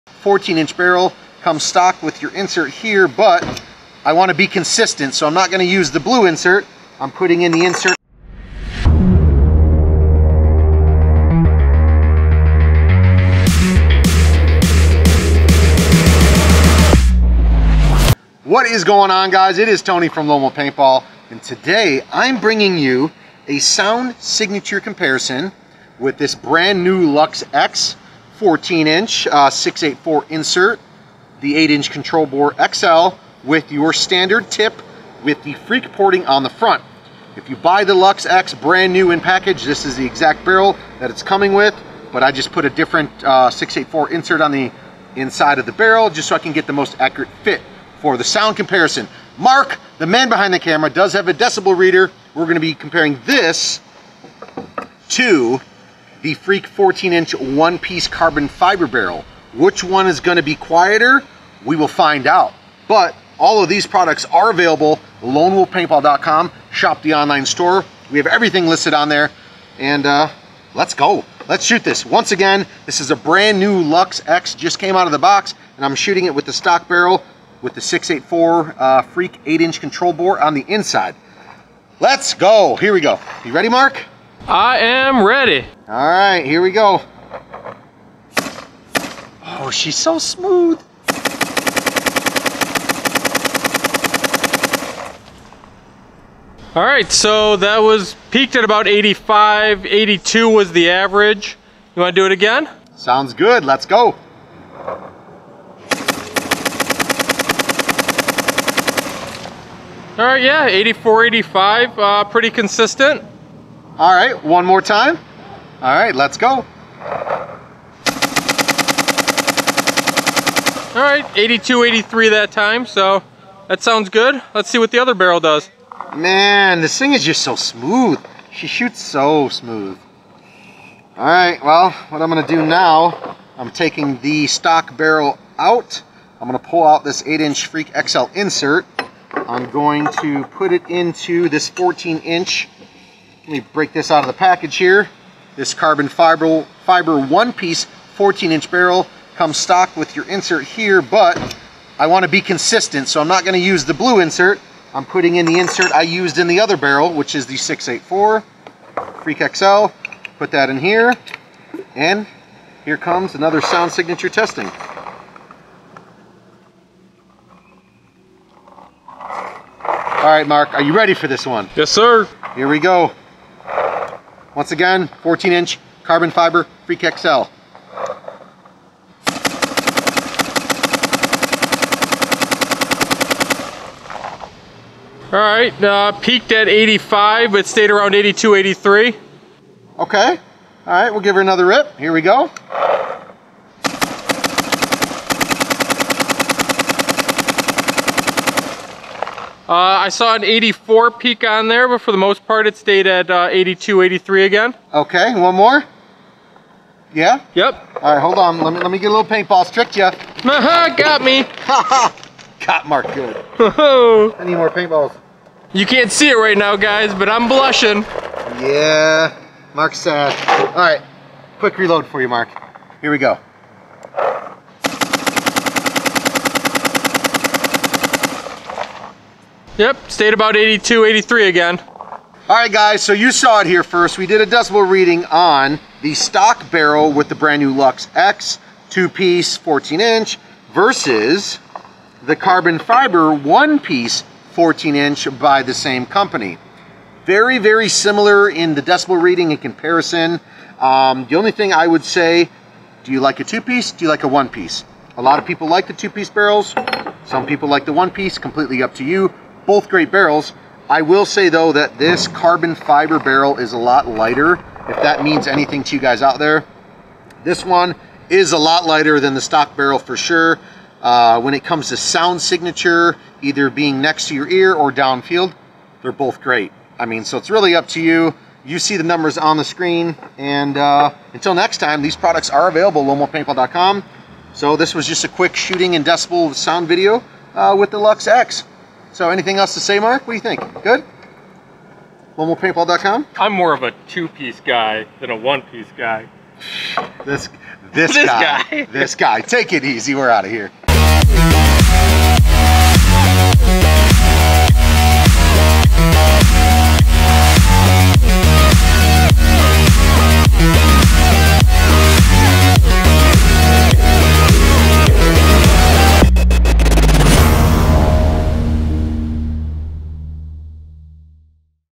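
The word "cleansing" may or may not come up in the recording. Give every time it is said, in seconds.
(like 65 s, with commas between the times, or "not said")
not said.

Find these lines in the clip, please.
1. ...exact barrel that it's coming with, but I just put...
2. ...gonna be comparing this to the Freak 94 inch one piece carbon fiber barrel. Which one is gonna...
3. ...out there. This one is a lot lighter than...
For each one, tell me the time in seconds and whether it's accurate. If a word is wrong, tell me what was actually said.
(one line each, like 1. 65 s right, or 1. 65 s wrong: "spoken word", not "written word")
1. 40 s right
2. 52 s wrong: "14", not "94"
3. 266 s right.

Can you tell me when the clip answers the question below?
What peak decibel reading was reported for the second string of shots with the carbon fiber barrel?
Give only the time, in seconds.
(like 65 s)
200 s.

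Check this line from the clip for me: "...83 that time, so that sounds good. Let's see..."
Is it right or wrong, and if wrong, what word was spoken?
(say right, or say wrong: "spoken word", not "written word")
right.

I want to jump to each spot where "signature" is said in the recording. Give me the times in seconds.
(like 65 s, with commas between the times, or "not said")
24 s, 163 s, 272 s.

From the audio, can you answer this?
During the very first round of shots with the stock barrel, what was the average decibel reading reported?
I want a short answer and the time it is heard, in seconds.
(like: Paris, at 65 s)
82, at 99 s.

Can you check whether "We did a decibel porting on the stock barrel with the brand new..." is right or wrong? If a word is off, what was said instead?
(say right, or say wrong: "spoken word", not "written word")
wrong: "reading", not "porting".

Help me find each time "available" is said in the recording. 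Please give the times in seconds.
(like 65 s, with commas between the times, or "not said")
64 s, 282 s.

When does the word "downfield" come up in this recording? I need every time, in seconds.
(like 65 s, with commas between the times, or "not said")
274 s.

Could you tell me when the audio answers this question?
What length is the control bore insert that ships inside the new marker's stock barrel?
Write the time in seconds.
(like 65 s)
31 s.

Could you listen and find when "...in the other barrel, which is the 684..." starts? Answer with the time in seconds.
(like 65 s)
156 s.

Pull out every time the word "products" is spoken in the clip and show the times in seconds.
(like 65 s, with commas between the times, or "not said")
63 s, 282 s.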